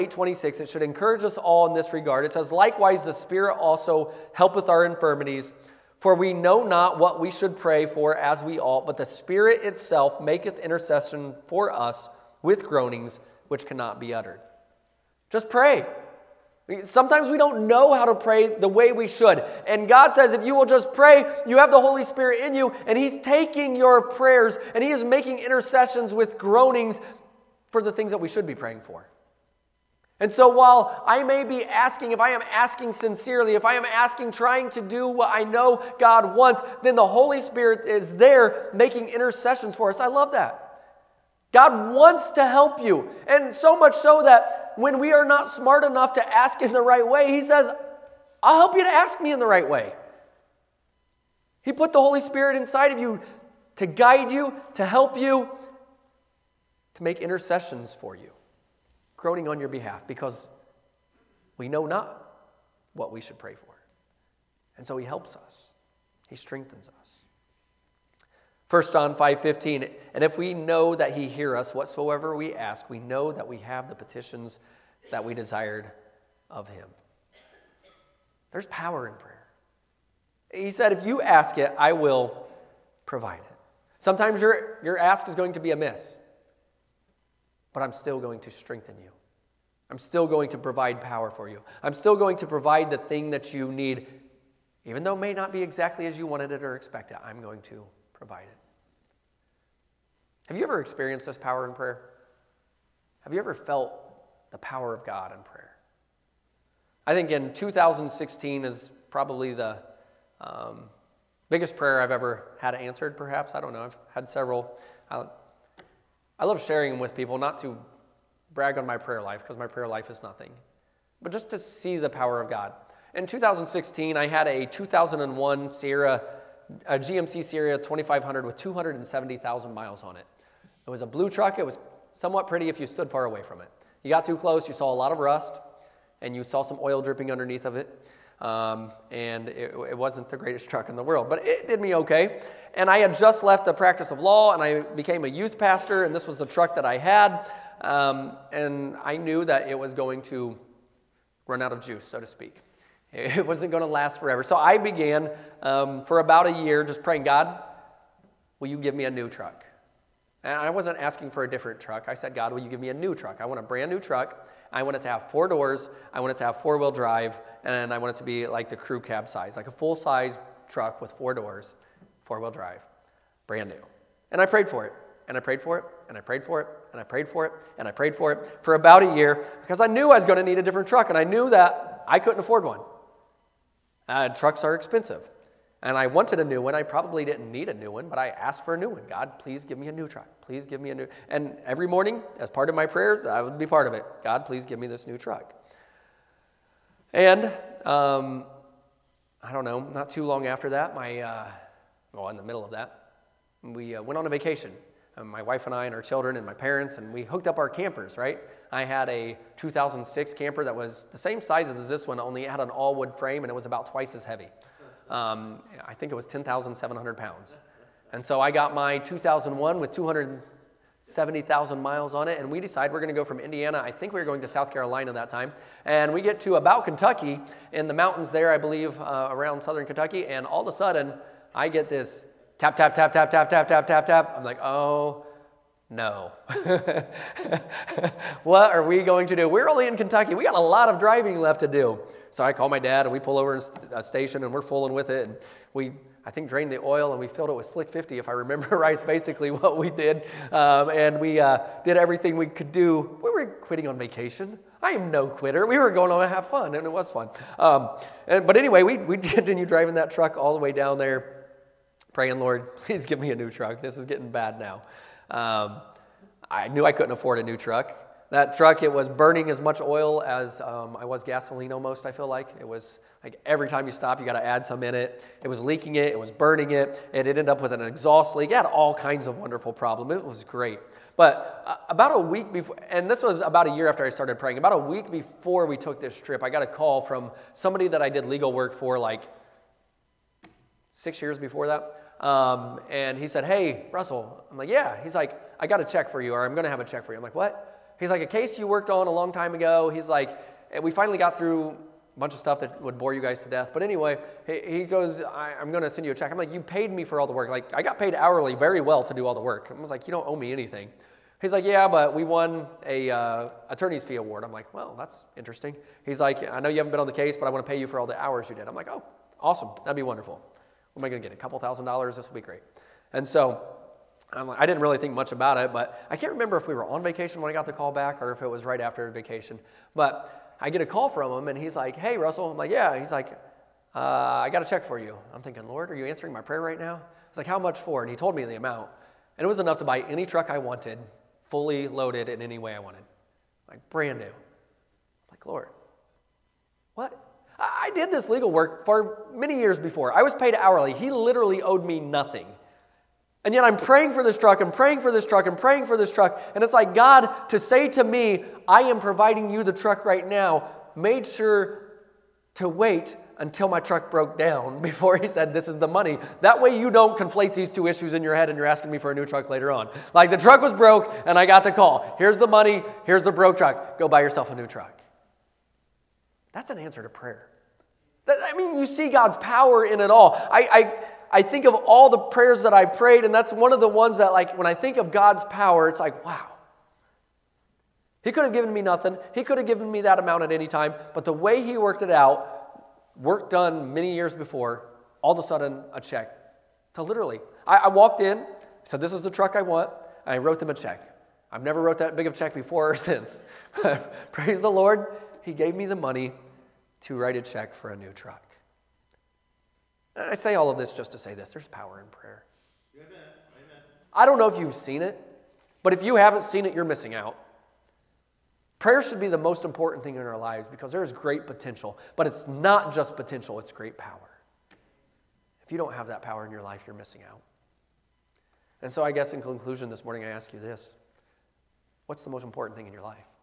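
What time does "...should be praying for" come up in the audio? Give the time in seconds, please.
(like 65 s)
28 s.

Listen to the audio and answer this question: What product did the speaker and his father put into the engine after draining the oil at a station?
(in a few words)
Slick 50.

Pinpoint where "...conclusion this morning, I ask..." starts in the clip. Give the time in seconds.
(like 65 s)
429 s.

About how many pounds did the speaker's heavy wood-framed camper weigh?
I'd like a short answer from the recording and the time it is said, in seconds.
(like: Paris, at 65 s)
10,700, at 216 s.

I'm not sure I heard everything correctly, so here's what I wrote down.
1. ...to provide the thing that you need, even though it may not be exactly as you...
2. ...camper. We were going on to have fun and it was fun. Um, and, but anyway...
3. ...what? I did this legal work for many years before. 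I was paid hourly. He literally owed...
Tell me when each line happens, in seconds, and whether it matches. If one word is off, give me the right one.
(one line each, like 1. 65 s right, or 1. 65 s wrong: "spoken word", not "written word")
1. 92 s right
2. 255 s wrong: "quitter", not "camper"
3. 346 s right.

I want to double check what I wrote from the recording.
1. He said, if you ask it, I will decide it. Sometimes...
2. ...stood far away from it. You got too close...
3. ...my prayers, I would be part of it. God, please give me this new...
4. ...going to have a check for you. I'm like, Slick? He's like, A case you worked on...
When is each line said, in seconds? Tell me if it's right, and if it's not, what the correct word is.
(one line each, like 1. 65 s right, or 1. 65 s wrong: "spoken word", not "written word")
1. 80 s wrong: "provide", not "decide"
2. 132 s right
3. 192 s right
4. 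296 s wrong: "What", not "Slick".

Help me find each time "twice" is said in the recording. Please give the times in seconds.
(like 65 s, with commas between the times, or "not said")
213 s.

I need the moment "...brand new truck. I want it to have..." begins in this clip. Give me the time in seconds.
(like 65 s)
163 s.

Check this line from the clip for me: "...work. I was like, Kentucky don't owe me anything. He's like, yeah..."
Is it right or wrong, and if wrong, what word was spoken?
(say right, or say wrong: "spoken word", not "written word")
wrong: "You", not "Kentucky".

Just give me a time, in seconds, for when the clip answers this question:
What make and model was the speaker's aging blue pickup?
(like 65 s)
126 s.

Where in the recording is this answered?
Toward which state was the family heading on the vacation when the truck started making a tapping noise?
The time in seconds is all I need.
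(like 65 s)
224 s.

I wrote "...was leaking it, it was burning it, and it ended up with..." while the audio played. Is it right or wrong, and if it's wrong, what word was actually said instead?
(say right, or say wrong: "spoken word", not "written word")
right.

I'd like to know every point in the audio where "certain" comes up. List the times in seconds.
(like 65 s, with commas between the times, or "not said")
not said.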